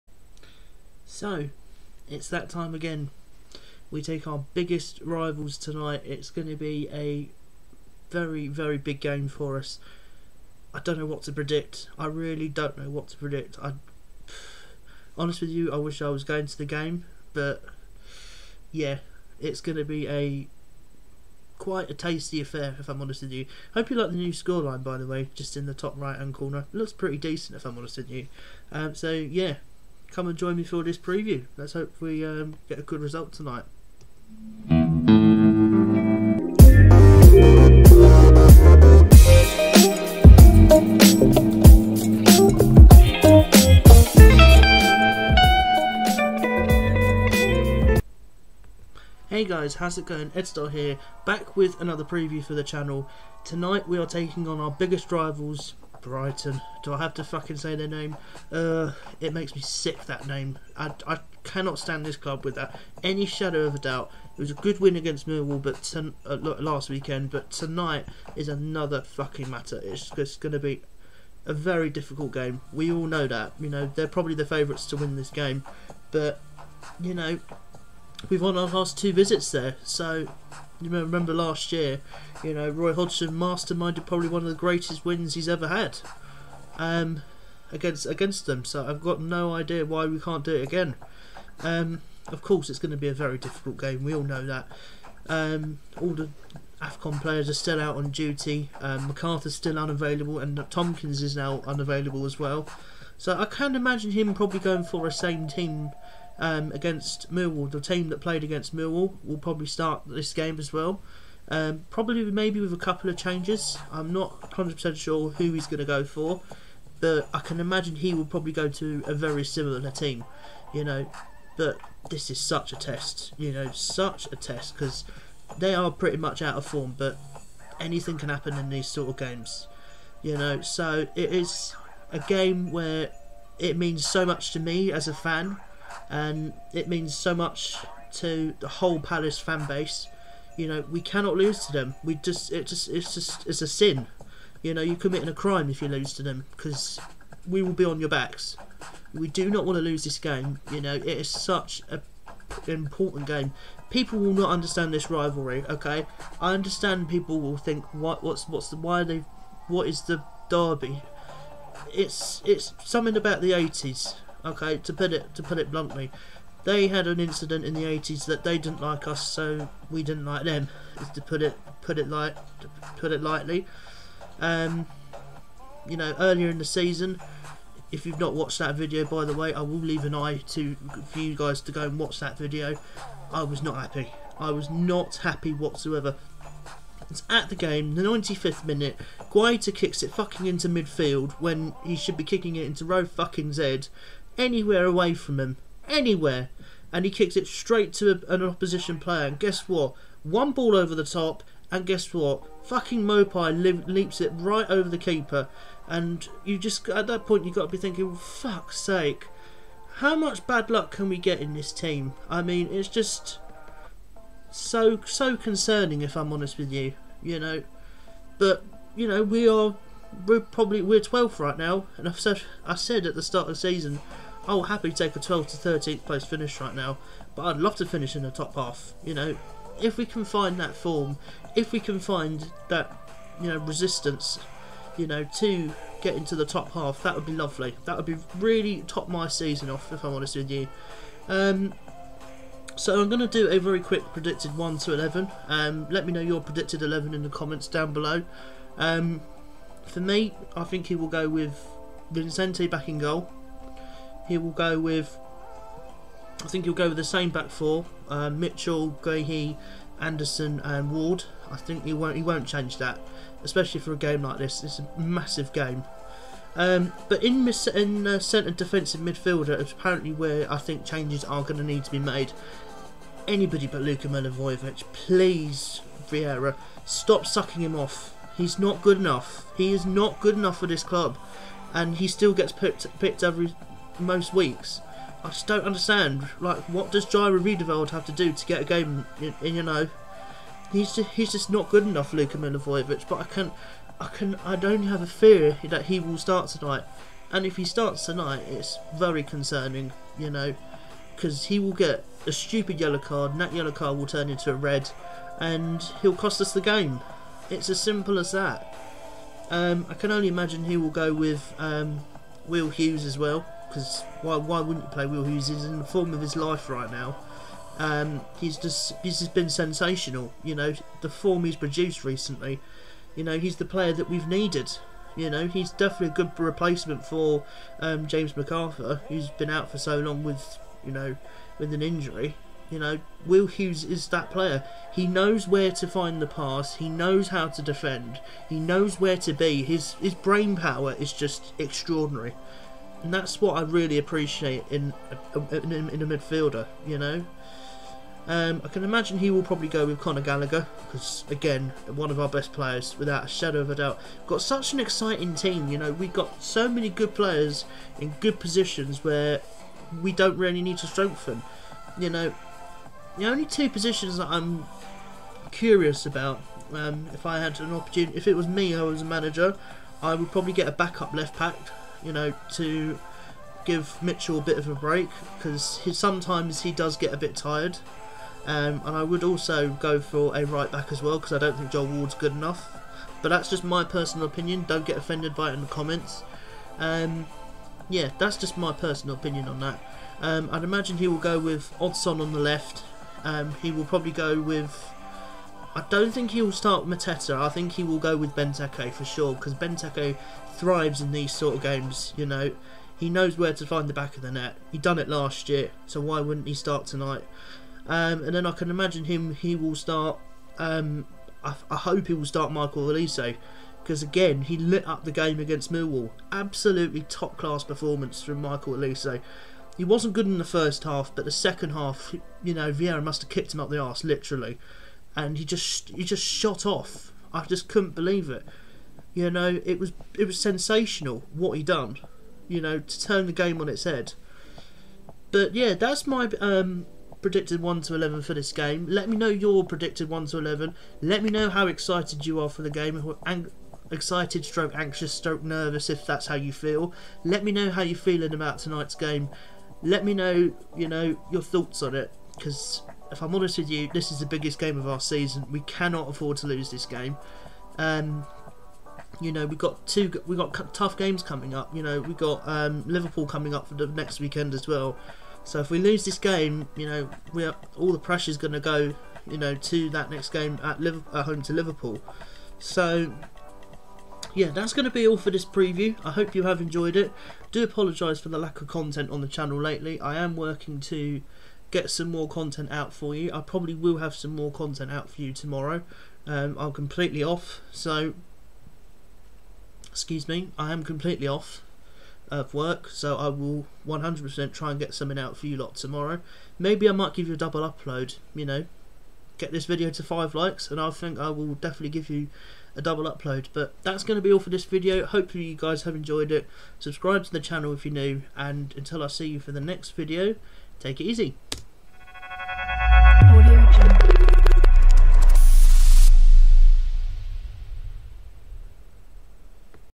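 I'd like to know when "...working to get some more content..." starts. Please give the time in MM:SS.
08:00.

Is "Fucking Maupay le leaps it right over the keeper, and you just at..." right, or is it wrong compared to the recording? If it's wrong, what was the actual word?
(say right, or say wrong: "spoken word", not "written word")
right.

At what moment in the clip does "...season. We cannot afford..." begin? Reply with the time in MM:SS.
07:34.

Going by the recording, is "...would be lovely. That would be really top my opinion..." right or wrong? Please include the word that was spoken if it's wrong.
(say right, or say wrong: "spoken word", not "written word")
wrong: "season", not "opinion".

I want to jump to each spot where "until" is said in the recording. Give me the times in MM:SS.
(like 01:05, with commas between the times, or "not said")
08:28.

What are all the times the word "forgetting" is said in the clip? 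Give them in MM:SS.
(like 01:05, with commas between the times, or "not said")
not said.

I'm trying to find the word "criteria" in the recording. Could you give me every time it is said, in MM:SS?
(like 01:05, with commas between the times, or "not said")
not said.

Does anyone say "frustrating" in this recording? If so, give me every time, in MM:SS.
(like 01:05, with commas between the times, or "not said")
not said.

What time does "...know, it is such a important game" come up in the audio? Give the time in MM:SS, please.
02:30.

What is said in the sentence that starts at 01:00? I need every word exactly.
I, I cannot stand this club without any shadow of a doubt.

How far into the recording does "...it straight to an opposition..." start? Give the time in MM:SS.
03:17.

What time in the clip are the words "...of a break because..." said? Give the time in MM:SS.
06:14.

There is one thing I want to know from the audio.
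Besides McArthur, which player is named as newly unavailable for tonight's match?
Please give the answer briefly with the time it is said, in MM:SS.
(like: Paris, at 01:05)
Tomkins, at 01:40.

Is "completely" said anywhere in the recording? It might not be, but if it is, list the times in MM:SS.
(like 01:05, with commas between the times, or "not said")
08:06, 08:10.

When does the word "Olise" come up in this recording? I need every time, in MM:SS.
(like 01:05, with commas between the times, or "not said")
06:52, 06:58.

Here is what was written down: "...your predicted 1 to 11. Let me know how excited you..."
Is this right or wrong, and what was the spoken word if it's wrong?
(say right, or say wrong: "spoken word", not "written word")
right.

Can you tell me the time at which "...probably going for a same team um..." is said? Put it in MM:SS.
01:44.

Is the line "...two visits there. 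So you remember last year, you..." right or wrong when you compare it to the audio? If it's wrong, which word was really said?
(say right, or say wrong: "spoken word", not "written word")
right.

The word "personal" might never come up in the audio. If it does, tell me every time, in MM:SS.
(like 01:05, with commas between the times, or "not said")
06:23, 06:28.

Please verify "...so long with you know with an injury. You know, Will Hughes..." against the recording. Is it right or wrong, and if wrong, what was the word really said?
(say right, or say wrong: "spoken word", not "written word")
right.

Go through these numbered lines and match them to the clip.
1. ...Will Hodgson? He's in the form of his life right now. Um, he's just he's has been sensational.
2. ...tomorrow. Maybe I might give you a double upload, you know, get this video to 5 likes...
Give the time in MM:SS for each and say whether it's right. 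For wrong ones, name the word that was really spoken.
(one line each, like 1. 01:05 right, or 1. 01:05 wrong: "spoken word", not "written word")
1. 05:15 wrong: "Hughes", not "Hodgson"
2. 08:15 right.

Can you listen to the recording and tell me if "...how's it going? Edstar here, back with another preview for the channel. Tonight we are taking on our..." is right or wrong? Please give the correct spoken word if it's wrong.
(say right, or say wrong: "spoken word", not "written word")
right.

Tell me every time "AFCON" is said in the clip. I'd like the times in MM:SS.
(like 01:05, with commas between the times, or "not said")
01:36.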